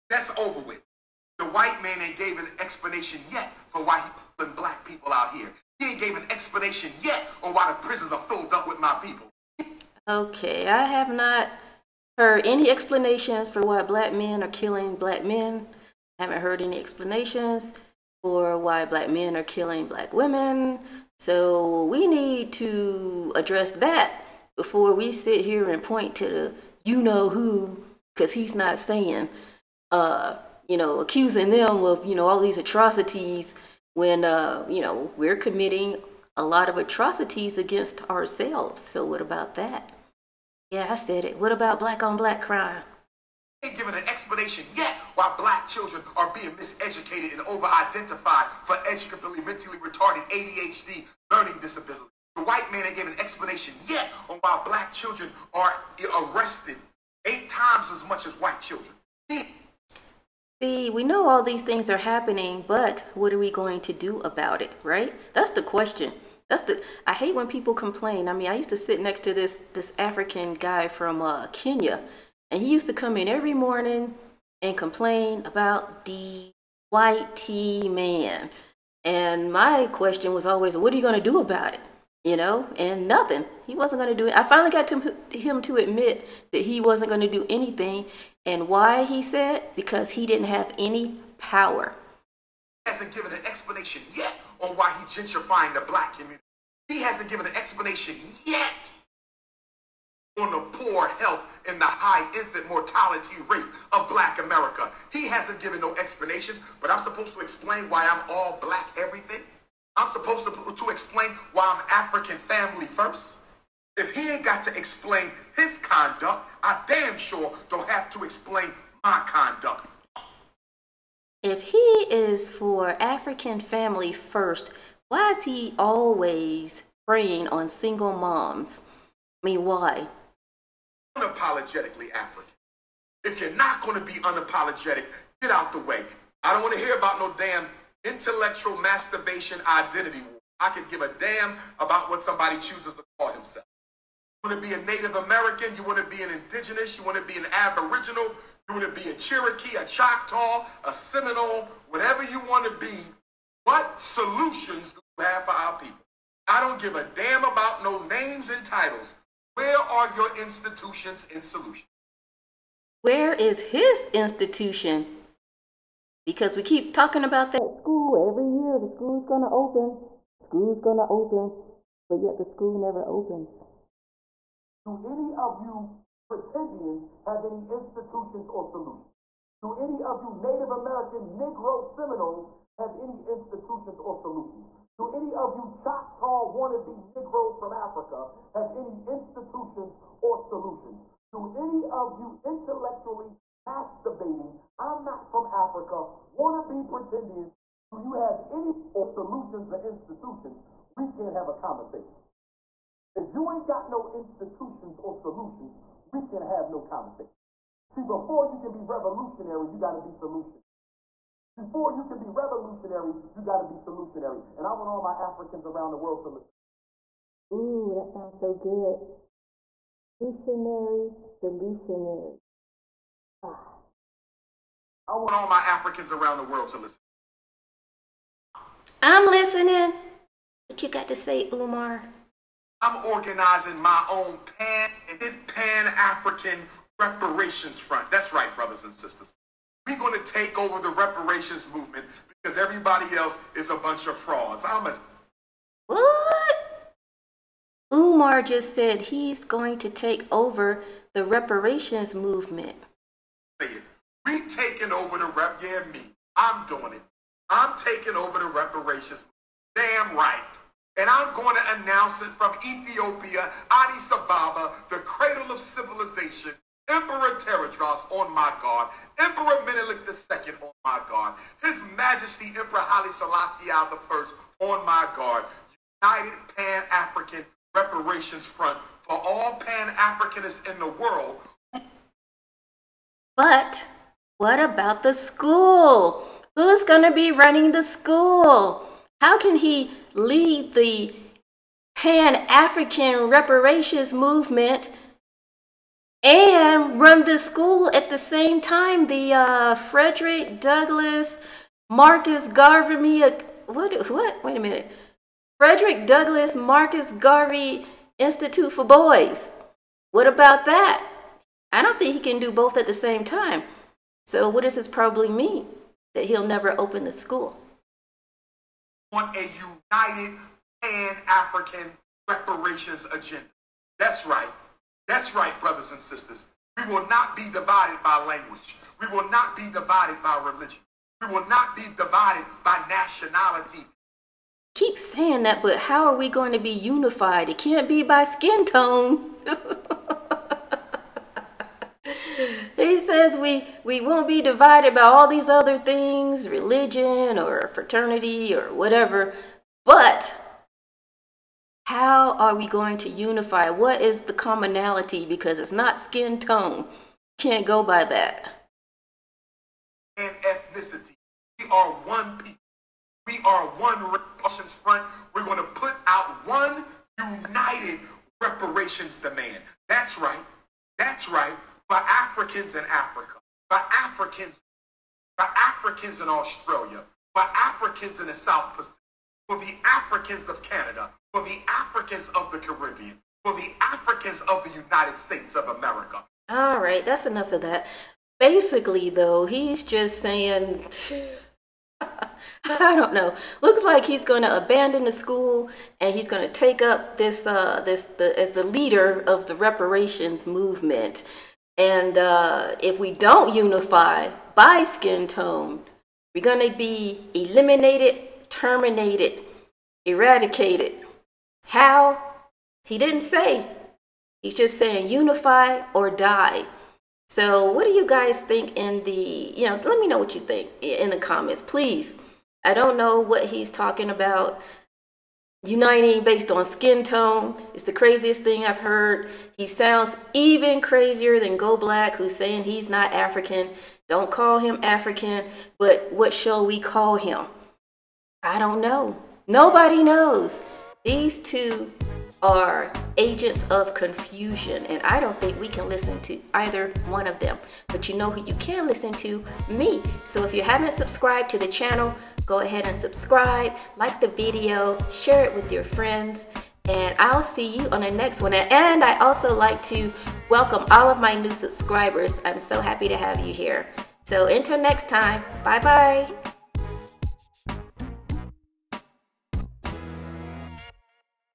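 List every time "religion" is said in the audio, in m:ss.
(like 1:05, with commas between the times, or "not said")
5:30, 5:46.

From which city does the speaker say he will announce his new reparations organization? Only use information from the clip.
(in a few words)
Addis Ababa.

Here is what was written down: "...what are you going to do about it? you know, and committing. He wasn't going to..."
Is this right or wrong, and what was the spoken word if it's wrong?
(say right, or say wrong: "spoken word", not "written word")
wrong: "nothing", not "committing".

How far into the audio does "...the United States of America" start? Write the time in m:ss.
6:24.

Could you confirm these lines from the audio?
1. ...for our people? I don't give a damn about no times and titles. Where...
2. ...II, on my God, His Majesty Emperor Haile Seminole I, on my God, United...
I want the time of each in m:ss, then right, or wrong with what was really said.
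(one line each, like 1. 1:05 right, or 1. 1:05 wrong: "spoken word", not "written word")
1. 2:35 wrong: "names", not "times"
2. 4:30 wrong: "Selassie", not "Seminole".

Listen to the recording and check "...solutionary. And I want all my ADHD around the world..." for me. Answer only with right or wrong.
wrong.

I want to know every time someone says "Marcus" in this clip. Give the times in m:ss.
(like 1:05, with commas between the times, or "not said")
5:01, 5:06.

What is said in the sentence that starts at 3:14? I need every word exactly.
I'm not from Africa Want to be pretendians, do you have any or solutions or institutions?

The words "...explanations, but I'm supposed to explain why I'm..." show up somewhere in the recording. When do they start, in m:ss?
1:45.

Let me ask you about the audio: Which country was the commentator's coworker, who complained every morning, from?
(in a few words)
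Kenya.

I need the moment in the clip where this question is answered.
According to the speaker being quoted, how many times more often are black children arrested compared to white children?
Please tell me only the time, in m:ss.
0:57.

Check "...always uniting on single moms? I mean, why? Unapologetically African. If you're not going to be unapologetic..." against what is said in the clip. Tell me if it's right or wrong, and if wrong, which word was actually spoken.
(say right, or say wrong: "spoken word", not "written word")
wrong: "preying", not "uniting".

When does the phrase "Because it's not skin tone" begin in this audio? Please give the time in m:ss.
5:55.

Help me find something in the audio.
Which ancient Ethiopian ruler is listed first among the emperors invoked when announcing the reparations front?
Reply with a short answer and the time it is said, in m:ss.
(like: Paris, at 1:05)
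Emperor Tewodros, at 4:26.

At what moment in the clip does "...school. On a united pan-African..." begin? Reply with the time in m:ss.
5:17.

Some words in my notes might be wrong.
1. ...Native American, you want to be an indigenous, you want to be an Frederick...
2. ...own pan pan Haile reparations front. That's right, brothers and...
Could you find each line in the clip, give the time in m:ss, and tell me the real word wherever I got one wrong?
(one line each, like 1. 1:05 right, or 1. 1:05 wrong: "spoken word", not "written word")
1. 2:24 wrong: "Aboriginal", not "Frederick"
2. 3:54 wrong: "African", not "Haile".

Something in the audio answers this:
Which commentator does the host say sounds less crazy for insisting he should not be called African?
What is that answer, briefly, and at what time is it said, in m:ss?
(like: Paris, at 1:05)
Go Black, at 7:11.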